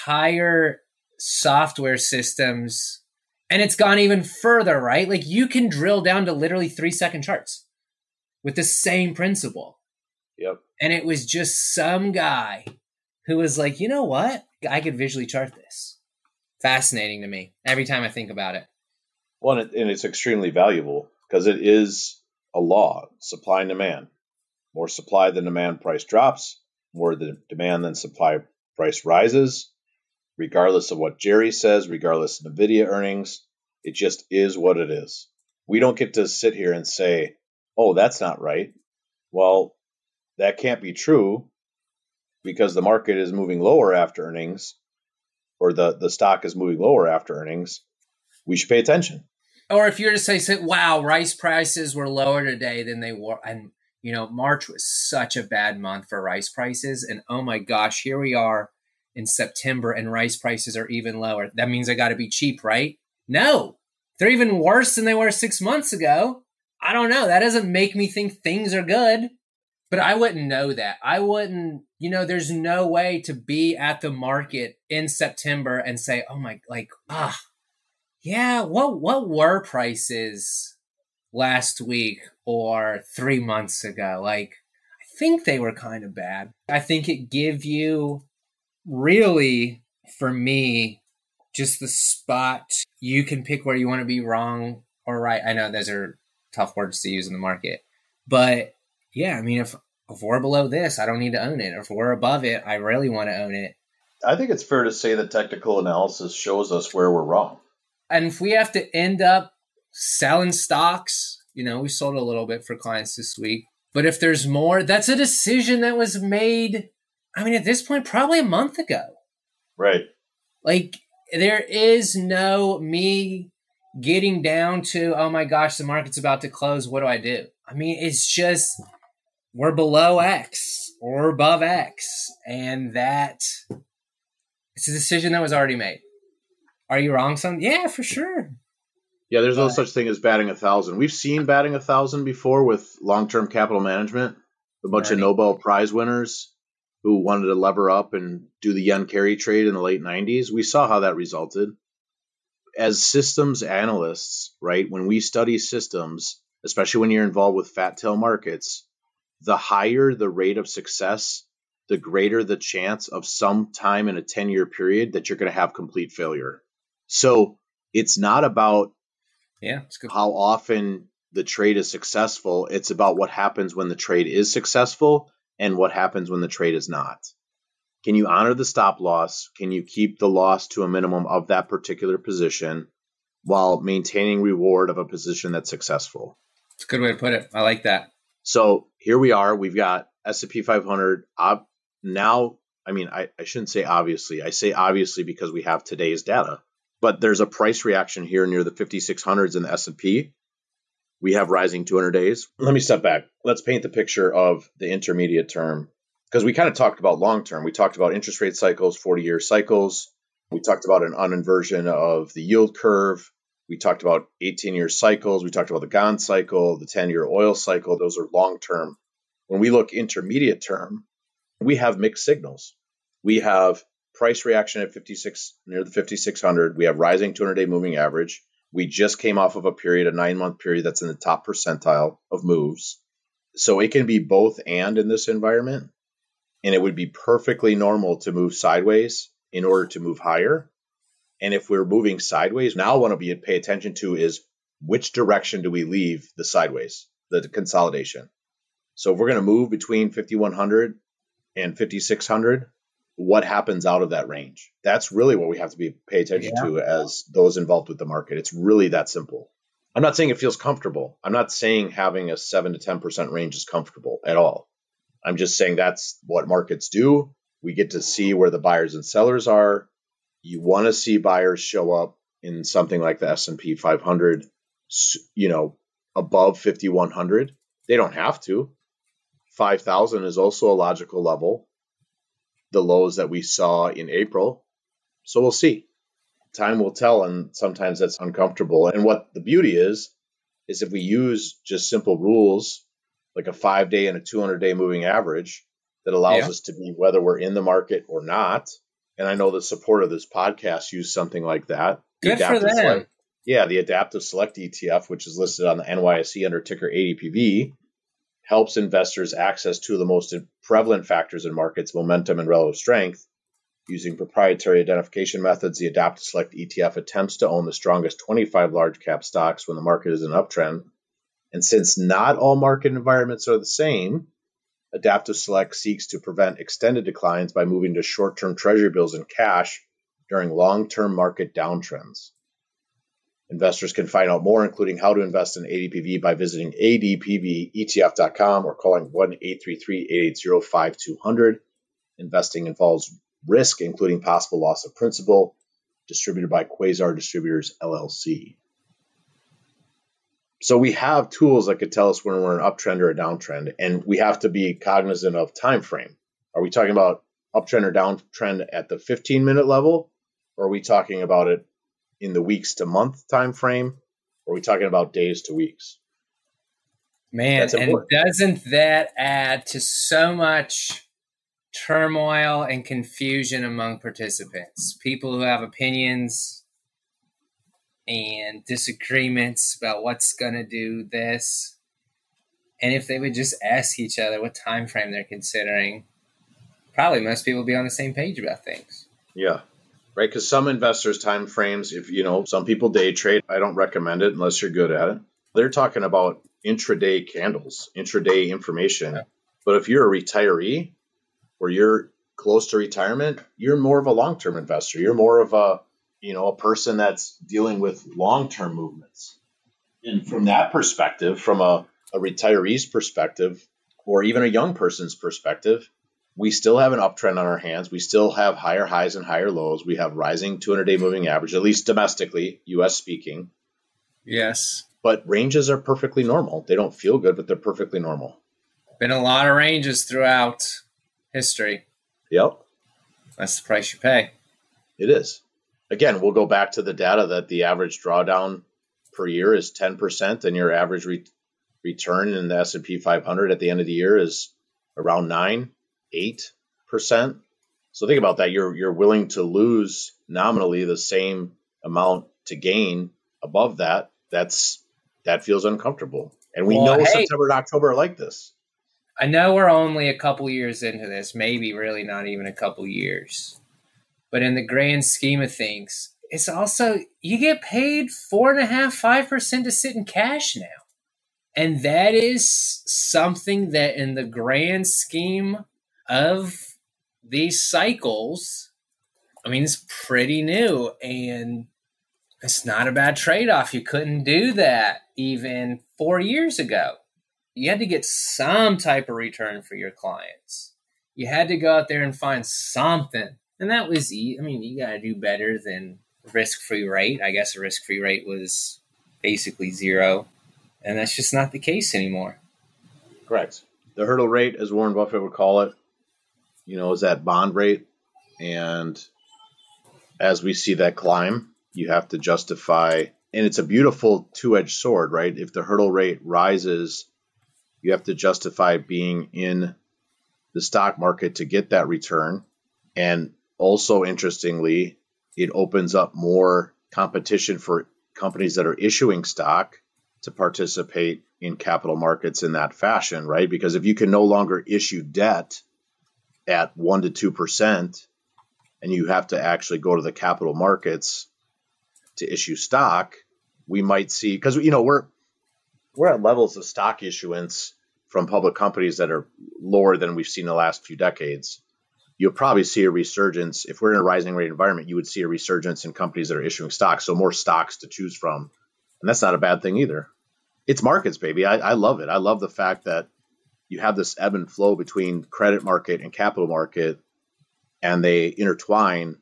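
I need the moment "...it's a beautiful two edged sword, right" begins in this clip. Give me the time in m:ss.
8:33.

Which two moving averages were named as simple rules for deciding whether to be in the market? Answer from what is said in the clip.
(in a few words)
5-day and 200-day.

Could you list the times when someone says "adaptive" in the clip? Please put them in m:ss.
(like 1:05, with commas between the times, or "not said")
5:03, 5:15, 5:24.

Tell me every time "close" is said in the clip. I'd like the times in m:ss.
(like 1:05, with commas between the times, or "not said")
2:06, 6:42.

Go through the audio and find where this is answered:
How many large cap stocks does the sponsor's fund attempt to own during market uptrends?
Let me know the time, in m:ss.
5:18.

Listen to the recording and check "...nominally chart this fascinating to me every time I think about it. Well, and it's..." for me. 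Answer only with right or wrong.
wrong.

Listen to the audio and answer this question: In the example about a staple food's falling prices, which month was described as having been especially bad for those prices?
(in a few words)
March.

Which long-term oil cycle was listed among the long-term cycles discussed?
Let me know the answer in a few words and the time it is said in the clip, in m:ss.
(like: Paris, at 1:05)
10 year oil cycle, at 3:36.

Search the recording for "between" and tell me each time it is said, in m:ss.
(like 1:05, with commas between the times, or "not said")
4:09, 9:24.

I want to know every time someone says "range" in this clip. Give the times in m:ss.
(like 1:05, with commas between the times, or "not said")
4:14, 4:23, 7:05, 7:09.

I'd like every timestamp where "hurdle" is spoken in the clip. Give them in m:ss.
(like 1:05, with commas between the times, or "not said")
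8:24, 8:35.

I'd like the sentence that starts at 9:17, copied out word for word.
So more stocks to choose from.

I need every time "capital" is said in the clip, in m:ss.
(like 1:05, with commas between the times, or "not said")
2:23, 8:51, 9:00, 9:26.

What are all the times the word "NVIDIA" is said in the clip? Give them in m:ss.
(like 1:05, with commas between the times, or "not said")
0:32.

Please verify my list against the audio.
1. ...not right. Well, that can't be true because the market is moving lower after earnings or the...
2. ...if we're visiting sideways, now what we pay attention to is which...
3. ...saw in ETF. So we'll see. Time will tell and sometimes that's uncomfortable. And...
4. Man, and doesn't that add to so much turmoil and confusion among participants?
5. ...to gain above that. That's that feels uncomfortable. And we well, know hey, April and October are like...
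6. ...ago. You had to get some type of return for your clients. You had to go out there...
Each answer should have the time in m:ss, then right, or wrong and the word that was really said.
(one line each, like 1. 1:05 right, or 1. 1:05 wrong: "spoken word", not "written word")
1. 0:38 right
2. 4:01 wrong: "moving", not "visiting"
3. 4:43 wrong: "April", not "ETF"
4. 6:07 right
5. 7:32 wrong: "September", not "April"
6. 8:06 right.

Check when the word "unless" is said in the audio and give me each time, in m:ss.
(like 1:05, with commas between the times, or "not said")
6:34.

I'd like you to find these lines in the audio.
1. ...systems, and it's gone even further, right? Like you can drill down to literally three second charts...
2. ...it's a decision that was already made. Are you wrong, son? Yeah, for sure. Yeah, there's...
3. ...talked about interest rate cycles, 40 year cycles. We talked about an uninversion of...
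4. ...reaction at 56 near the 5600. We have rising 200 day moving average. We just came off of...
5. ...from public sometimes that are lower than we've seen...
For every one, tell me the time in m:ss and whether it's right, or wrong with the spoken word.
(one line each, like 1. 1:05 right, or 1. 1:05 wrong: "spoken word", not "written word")
1. 0:01 right
2. 2:14 right
3. 3:27 right
4. 3:44 right
5. 9:08 wrong: "companies", not "sometimes".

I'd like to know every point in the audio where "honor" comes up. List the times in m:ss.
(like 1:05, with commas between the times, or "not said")
2:58.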